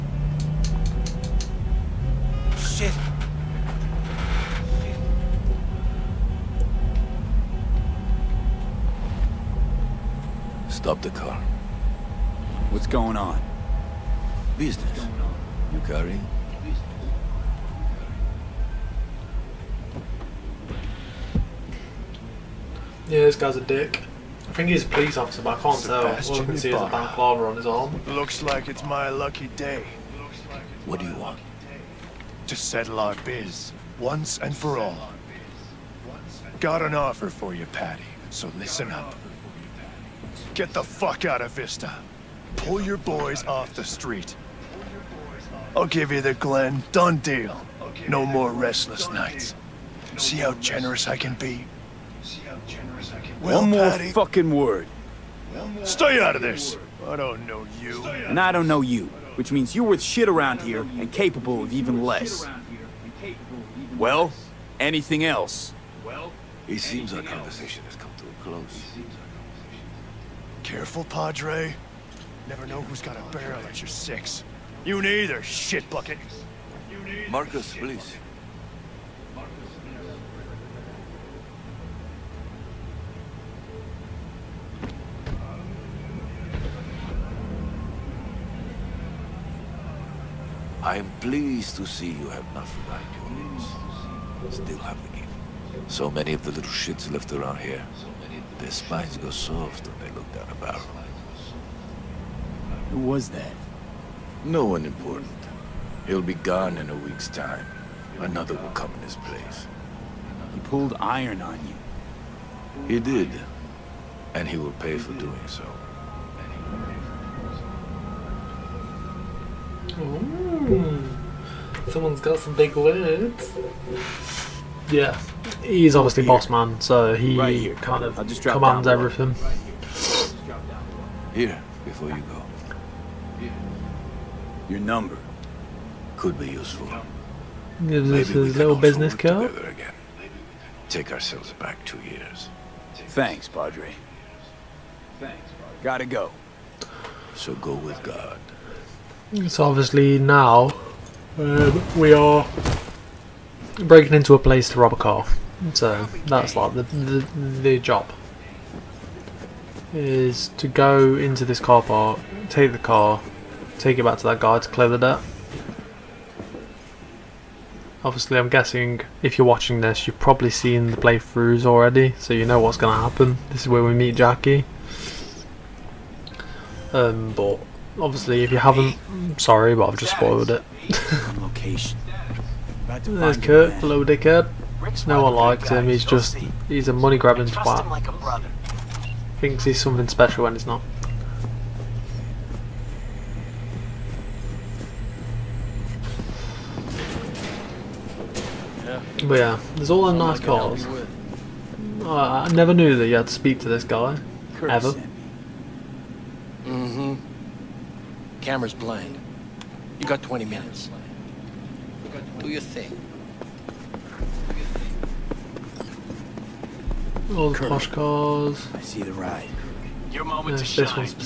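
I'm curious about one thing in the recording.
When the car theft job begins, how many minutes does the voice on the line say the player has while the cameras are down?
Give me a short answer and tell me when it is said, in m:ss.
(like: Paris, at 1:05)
20, at 3:30.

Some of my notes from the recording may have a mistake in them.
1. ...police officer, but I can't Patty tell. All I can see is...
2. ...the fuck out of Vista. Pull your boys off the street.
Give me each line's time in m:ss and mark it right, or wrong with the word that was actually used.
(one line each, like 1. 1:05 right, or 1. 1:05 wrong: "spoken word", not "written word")
1. 0:24 wrong: "Sebastian", not "Patty"
2. 0:40 right.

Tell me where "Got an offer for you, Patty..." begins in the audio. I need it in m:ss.
0:36.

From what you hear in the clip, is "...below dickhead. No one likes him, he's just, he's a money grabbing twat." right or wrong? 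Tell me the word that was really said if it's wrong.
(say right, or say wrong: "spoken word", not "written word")
right.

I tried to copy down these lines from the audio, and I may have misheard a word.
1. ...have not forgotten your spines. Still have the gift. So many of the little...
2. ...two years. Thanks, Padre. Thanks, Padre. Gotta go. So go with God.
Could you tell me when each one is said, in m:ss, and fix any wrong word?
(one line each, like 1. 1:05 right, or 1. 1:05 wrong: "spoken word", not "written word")
1. 1:32 wrong: "names", not "spines"
2. 2:21 right.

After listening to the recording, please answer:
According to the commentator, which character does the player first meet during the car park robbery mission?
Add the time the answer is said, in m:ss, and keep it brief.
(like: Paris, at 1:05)
Jackie, at 2:54.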